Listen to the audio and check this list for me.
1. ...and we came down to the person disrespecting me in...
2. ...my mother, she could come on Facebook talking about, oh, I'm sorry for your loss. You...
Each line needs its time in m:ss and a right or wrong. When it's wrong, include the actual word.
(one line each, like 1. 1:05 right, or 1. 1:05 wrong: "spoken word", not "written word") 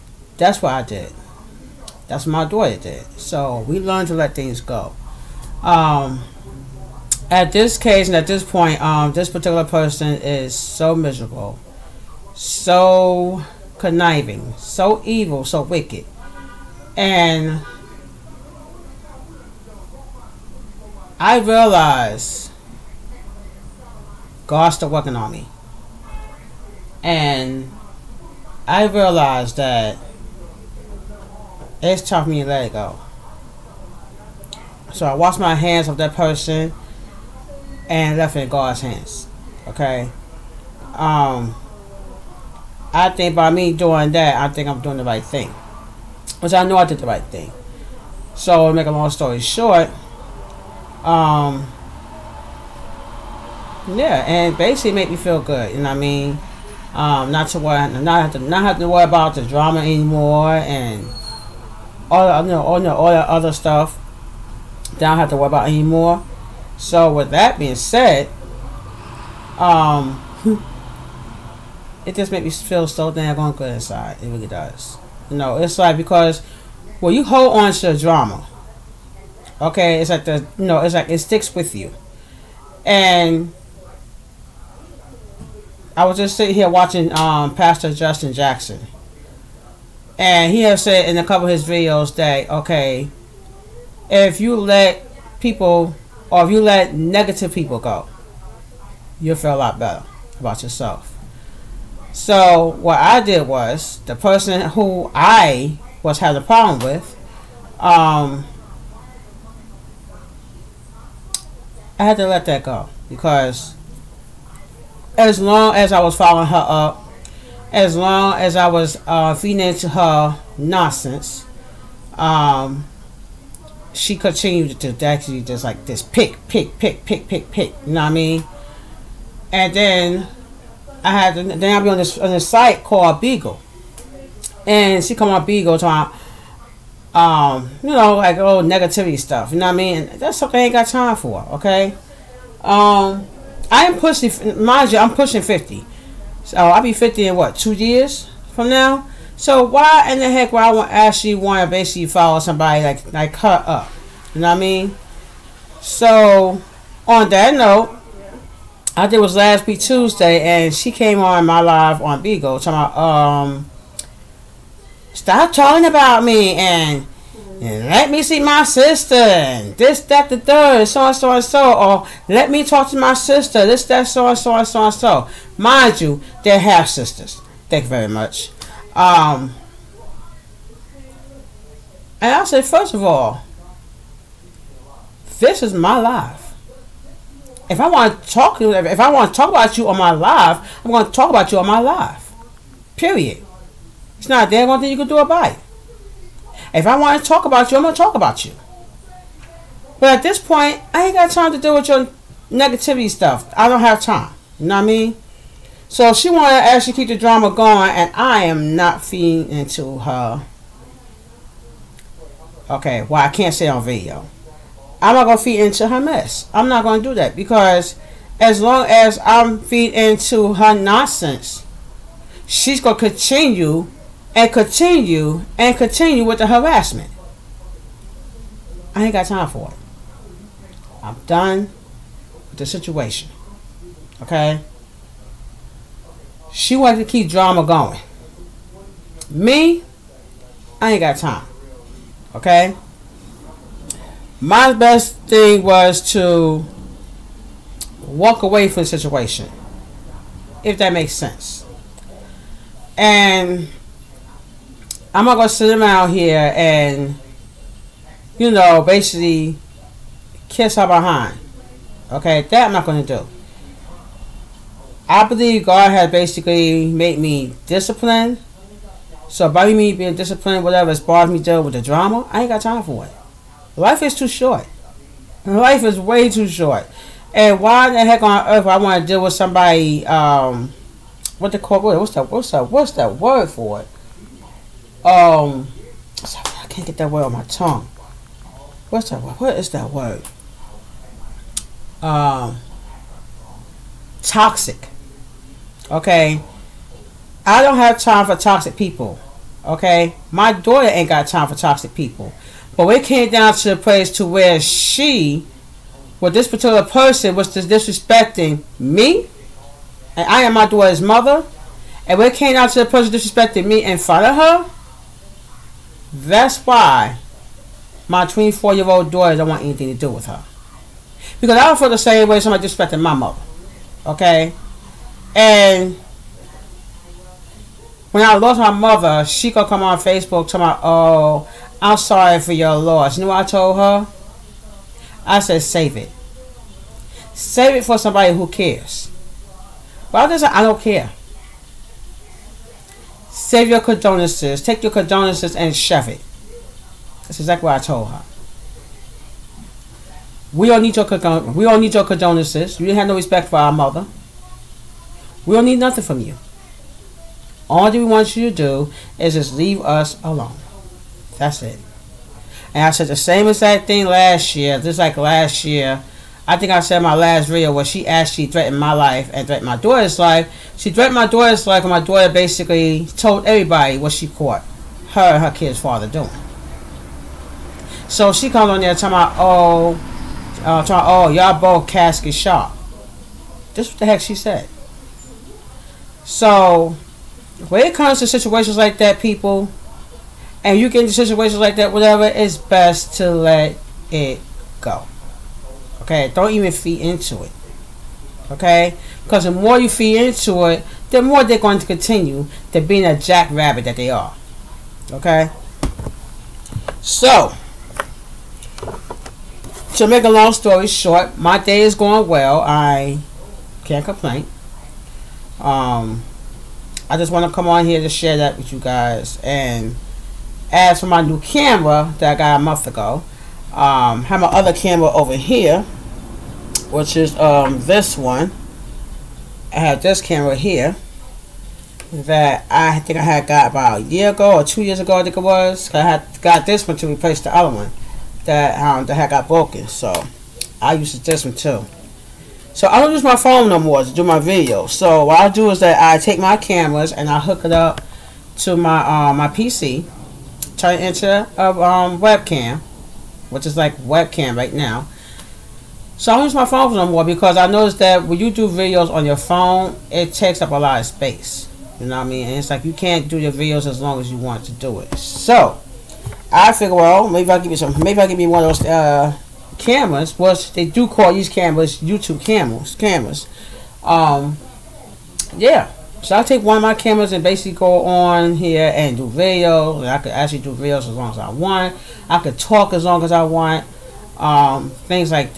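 1. 5:12 right
2. 5:28 right.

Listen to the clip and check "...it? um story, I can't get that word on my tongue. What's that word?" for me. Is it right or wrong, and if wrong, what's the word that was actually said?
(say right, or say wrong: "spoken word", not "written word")
wrong: "sorry", not "story".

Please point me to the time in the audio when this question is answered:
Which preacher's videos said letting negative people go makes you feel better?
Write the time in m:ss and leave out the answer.
1:27.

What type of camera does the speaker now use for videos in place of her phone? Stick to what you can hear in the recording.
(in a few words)
YouTube cameras.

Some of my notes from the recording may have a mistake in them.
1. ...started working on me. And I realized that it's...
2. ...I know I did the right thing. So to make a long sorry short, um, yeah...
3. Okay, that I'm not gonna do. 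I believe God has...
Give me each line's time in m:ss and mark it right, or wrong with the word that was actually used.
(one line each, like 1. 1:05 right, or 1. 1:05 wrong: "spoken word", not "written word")
1. 0:24 right
2. 0:46 wrong: "story", not "sorry"
3. 4:22 right.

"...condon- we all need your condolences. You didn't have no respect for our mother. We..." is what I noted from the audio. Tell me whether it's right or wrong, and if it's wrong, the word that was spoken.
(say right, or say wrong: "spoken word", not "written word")
right.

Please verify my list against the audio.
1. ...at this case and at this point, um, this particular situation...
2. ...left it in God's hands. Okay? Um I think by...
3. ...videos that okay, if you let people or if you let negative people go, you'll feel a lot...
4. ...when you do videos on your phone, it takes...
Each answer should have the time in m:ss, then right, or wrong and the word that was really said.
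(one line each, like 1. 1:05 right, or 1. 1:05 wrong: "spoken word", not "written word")
1. 0:07 wrong: "person", not "situation"
2. 0:38 right
3. 1:31 right
4. 7:38 right.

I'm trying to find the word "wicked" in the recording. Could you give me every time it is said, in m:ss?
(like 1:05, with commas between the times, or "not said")
0:15.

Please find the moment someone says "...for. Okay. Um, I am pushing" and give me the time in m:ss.
2:21.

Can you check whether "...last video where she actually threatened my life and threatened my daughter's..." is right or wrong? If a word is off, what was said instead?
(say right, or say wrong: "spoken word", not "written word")
right.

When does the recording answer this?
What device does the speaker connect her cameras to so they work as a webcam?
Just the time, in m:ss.
7:29.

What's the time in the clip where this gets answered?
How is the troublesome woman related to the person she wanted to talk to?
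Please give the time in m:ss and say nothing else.
2:56.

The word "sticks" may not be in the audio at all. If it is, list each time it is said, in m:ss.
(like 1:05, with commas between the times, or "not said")
1:21.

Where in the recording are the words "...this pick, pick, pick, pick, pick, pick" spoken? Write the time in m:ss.
2:05.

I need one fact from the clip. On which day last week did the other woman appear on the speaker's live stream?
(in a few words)
Tuesday.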